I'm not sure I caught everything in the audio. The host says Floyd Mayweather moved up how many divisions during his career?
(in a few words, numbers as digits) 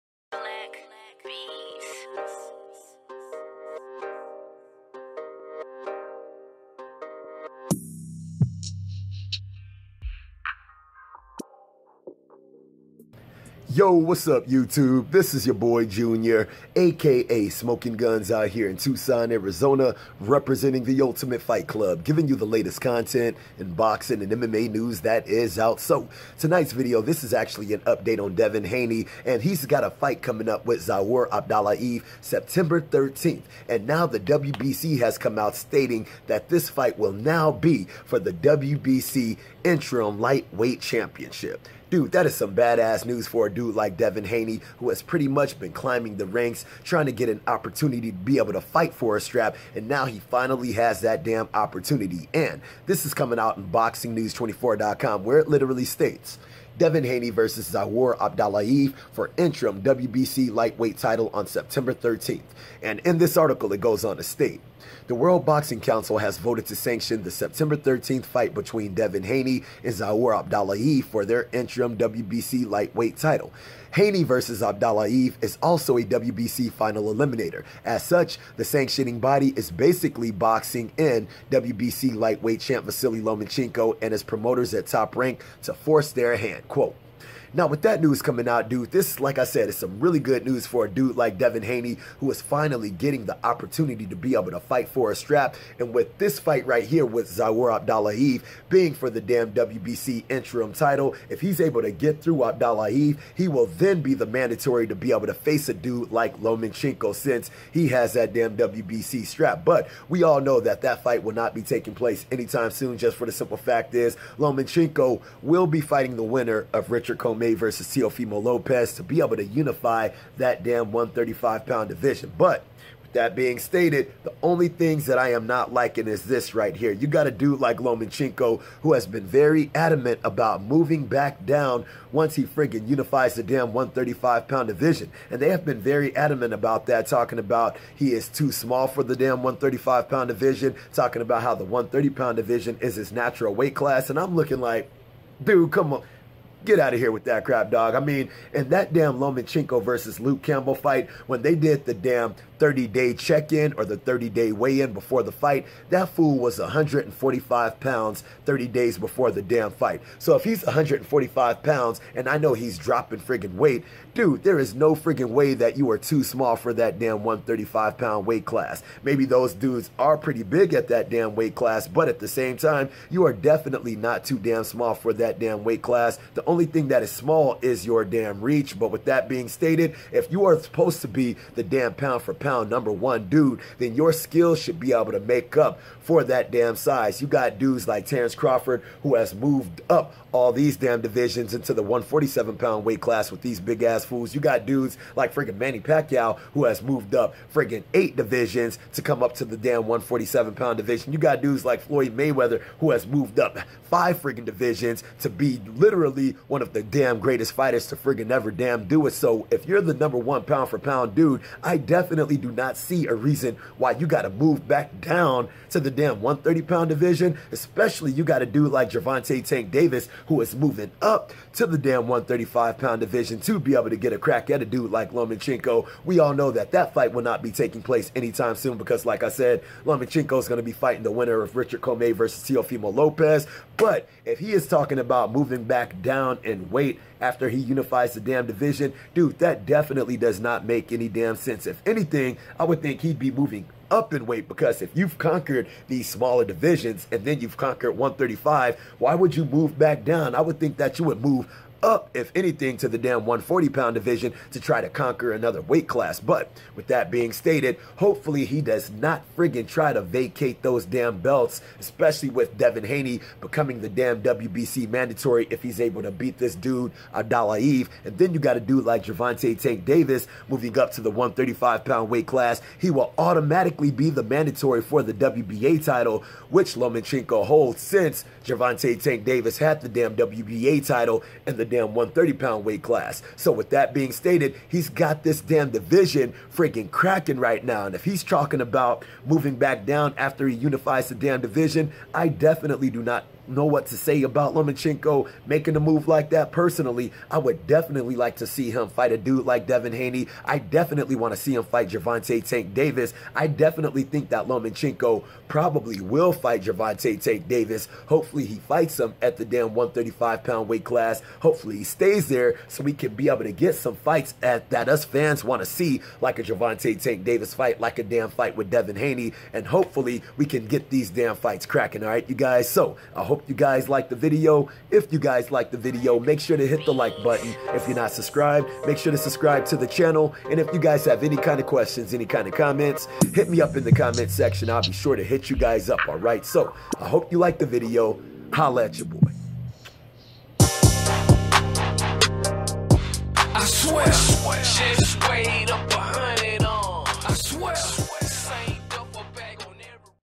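5.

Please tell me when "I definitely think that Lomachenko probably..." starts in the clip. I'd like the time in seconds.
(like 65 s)
303 s.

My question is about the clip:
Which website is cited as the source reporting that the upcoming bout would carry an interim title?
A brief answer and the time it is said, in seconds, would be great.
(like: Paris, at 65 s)
BoxingNews24.com, at 53 s.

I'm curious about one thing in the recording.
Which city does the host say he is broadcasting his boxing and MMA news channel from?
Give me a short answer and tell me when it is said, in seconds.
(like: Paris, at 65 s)
Tucson, Arizona, at 18 s.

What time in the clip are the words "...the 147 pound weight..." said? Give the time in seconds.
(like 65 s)
191 s.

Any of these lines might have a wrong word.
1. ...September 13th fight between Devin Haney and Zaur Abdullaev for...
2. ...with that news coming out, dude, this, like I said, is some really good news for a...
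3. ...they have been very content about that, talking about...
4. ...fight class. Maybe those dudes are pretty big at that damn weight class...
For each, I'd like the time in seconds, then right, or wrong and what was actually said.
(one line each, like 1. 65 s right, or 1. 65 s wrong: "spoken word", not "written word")
1. 67 s right
2. 87 s right
3. 135 s wrong: "adamant", not "content"
4. 168 s wrong: "weight", not "fight".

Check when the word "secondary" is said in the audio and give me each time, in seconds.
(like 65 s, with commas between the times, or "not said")
not said.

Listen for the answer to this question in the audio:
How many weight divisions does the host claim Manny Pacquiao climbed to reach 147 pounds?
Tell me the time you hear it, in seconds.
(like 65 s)
197 s.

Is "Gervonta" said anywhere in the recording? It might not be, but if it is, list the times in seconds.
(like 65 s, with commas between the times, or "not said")
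218 s, 269 s, 278 s, 301 s, 306 s, 316 s.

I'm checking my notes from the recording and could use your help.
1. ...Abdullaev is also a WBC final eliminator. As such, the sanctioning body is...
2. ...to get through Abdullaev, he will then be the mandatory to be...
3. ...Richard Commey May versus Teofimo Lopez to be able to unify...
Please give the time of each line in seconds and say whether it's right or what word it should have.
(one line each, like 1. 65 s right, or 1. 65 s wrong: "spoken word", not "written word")
1. 74 s right
2. 101 s right
3. 116 s right.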